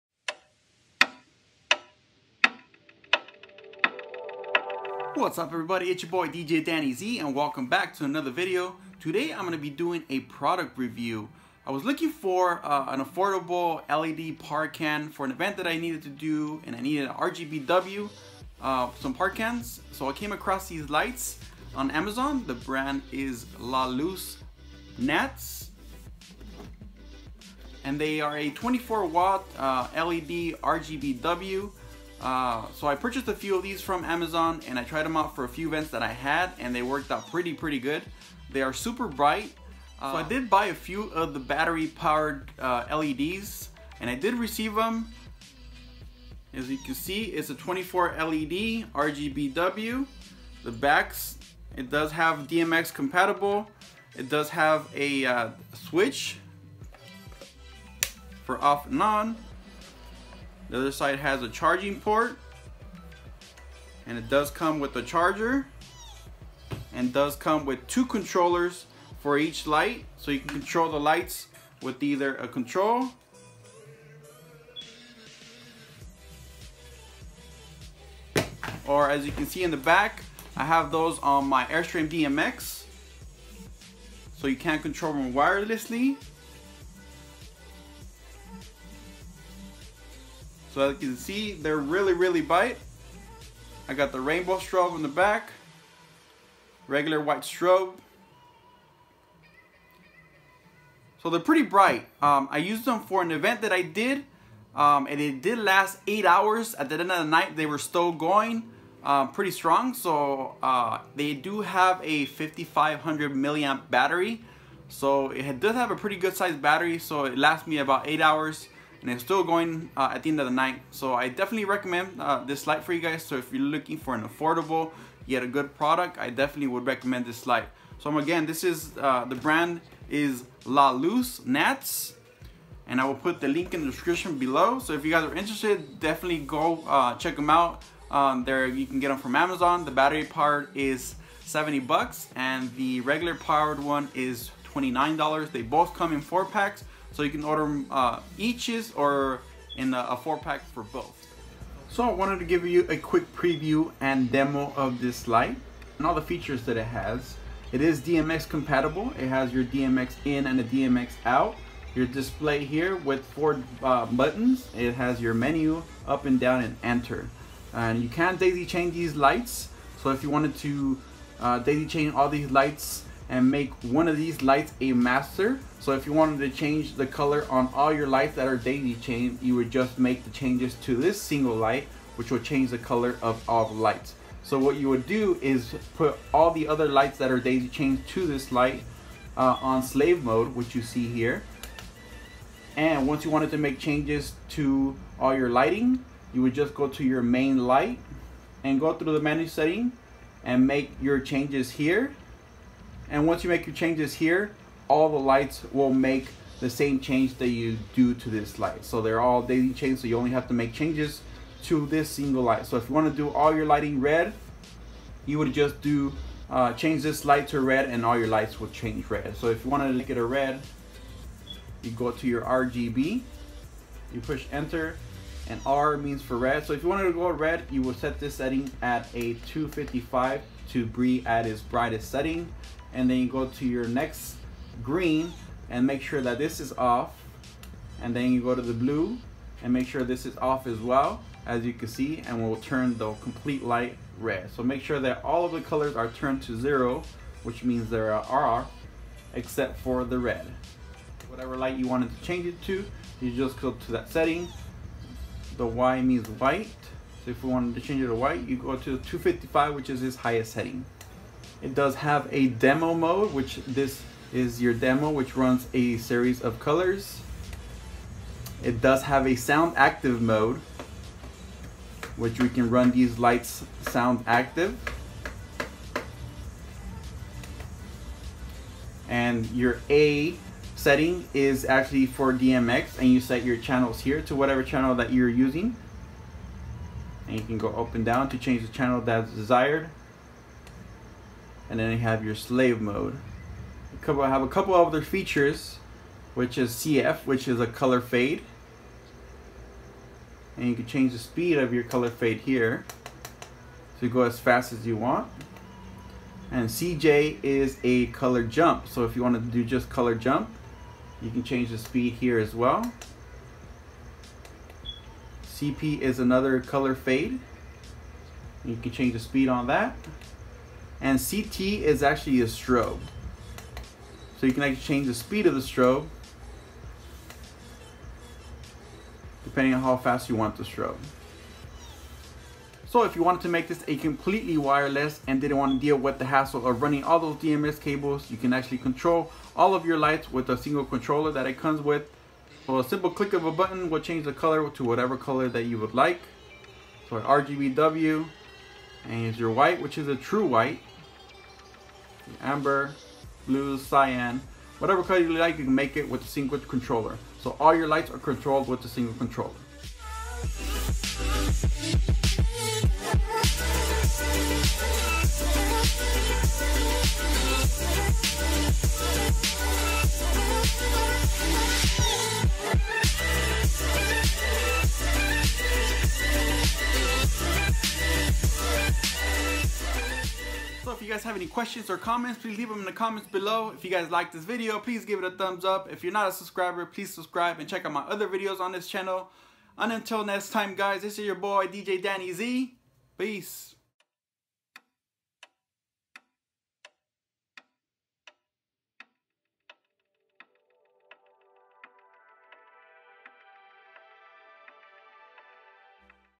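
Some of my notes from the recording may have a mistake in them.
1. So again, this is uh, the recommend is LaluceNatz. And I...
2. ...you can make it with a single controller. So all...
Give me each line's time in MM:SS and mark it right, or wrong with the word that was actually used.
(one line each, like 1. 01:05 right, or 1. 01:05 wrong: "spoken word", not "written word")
1. 02:07 wrong: "brand", not "recommend"
2. 05:55 right.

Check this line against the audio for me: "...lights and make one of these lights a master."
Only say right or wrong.
right.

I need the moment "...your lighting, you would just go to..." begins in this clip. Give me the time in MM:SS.
03:15.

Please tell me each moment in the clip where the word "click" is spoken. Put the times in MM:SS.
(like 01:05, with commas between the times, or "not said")
05:43.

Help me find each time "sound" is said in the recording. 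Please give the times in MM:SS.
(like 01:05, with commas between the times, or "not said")
04:29, 04:33.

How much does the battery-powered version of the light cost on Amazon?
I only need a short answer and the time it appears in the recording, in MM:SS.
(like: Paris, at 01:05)
$70, at 02:21.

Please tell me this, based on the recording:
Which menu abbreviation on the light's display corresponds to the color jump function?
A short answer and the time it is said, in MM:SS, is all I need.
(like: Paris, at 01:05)
CJ, at 05:06.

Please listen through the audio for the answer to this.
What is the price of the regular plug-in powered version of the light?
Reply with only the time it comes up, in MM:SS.
02:24.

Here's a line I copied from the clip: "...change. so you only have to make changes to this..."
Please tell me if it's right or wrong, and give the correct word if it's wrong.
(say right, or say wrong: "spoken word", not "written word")
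right.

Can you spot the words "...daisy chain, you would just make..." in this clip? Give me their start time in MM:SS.
02:58.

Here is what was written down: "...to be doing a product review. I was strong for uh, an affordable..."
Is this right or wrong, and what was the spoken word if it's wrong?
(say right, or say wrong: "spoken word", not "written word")
wrong: "looking", not "strong".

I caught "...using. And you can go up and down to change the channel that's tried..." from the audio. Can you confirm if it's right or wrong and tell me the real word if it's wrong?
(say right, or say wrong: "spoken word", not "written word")
wrong: "desired", not "tried".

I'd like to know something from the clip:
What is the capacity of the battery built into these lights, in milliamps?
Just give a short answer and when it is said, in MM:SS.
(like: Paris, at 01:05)
5500, at 01:52.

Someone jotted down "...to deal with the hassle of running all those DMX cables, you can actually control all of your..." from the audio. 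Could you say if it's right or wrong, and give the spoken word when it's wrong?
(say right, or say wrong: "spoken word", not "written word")
right.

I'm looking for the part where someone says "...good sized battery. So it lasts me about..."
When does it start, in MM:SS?
01:56.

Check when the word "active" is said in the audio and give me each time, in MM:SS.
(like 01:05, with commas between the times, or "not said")
04:29, 04:34.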